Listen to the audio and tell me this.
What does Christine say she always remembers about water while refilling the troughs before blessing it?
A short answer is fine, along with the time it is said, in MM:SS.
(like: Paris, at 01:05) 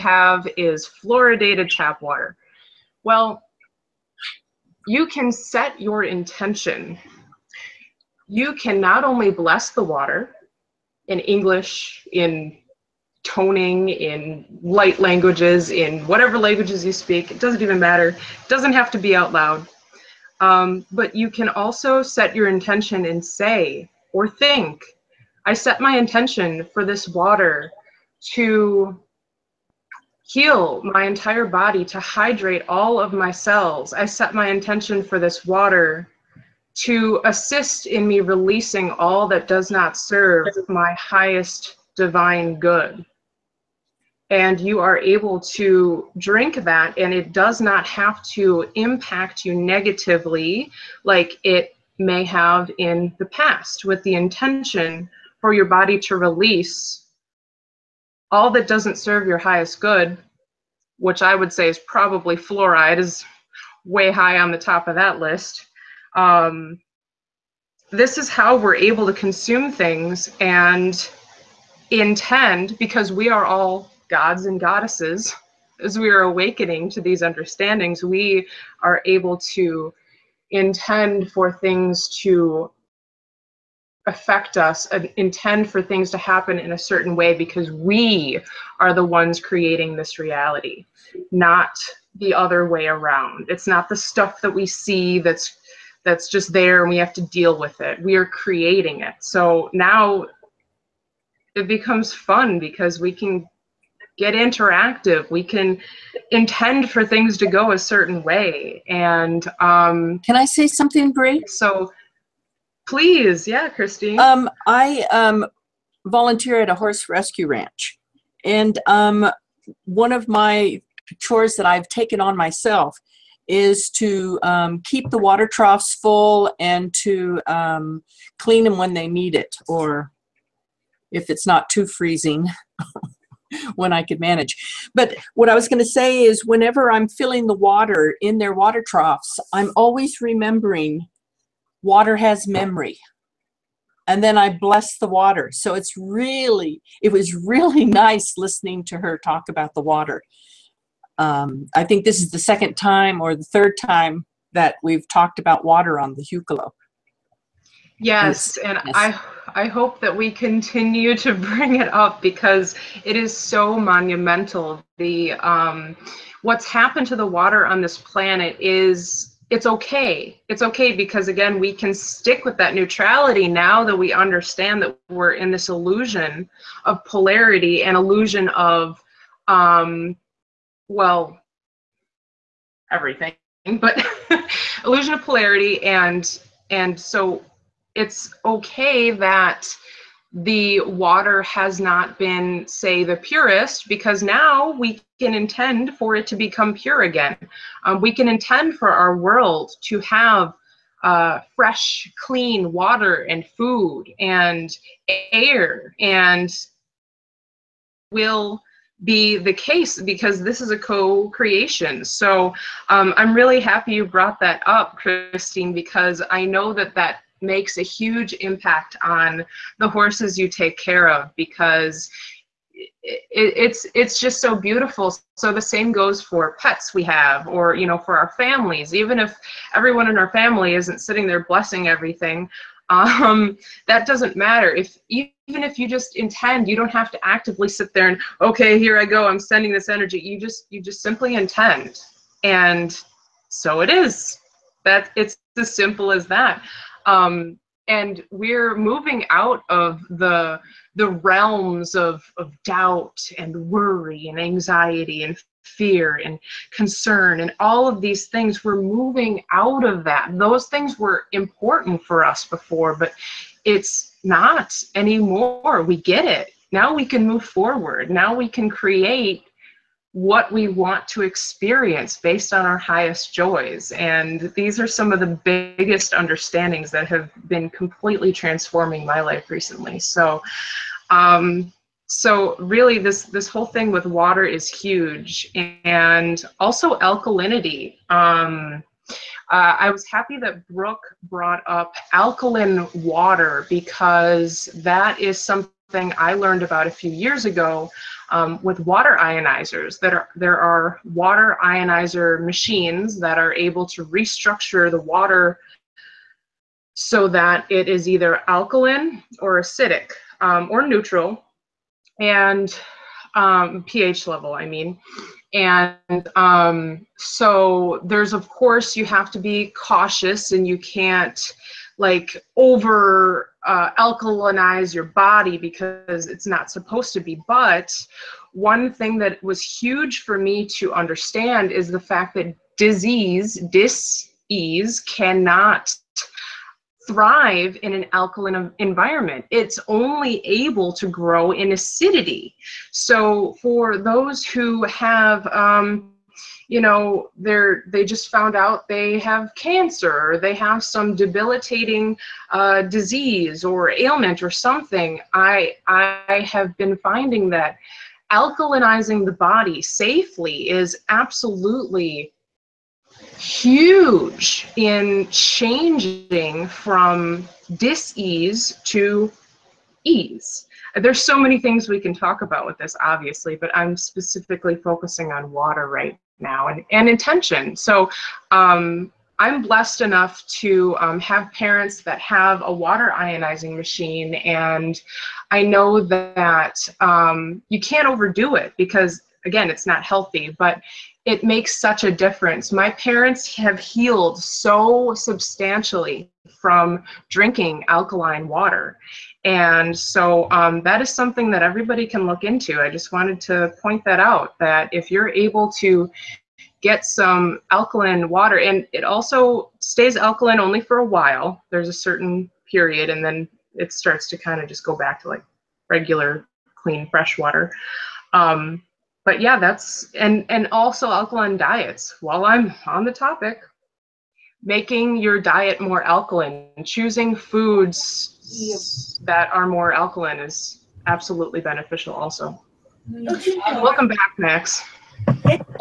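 Water has memory, at 02:21.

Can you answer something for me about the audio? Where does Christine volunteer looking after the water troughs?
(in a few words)
A horse rescue ranch.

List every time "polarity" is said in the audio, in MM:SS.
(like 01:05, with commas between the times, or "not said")
02:57, 03:05.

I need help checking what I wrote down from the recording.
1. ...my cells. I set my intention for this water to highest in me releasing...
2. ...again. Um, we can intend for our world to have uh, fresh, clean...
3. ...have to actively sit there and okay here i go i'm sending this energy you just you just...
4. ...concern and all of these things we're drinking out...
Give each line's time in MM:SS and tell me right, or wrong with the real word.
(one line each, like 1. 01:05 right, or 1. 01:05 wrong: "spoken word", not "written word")
1. 00:33 wrong: "assist", not "highest"
2. 03:17 right
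3. 03:56 right
4. 04:16 wrong: "moving", not "drinking".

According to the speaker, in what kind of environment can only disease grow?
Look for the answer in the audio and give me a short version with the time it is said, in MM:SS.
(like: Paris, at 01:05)
Acidity, at 05:41.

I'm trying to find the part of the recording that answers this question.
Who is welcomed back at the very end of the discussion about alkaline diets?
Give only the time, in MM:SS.
07:14.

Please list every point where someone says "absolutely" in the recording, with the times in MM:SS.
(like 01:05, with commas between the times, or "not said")
06:01, 07:11.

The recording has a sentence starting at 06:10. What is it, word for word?
There's so many things we can talk about with this, obviously, but I'm specifically focusing on water right now and, and intention.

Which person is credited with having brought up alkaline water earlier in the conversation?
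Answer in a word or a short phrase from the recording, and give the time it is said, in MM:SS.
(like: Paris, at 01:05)
Brook, at 04:50.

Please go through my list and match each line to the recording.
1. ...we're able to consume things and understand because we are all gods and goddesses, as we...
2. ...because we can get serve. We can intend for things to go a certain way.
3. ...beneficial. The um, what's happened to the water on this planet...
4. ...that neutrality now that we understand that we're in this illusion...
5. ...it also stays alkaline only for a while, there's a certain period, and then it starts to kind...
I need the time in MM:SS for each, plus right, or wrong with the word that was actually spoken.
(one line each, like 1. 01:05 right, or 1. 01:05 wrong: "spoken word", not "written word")
1. 01:08 wrong: "intend", not "understand"
2. 01:42 wrong: "interactive", not "serve"
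3. 02:43 wrong: "monumental", not "beneficial"
4. 02:52 right
5. 06:48 right.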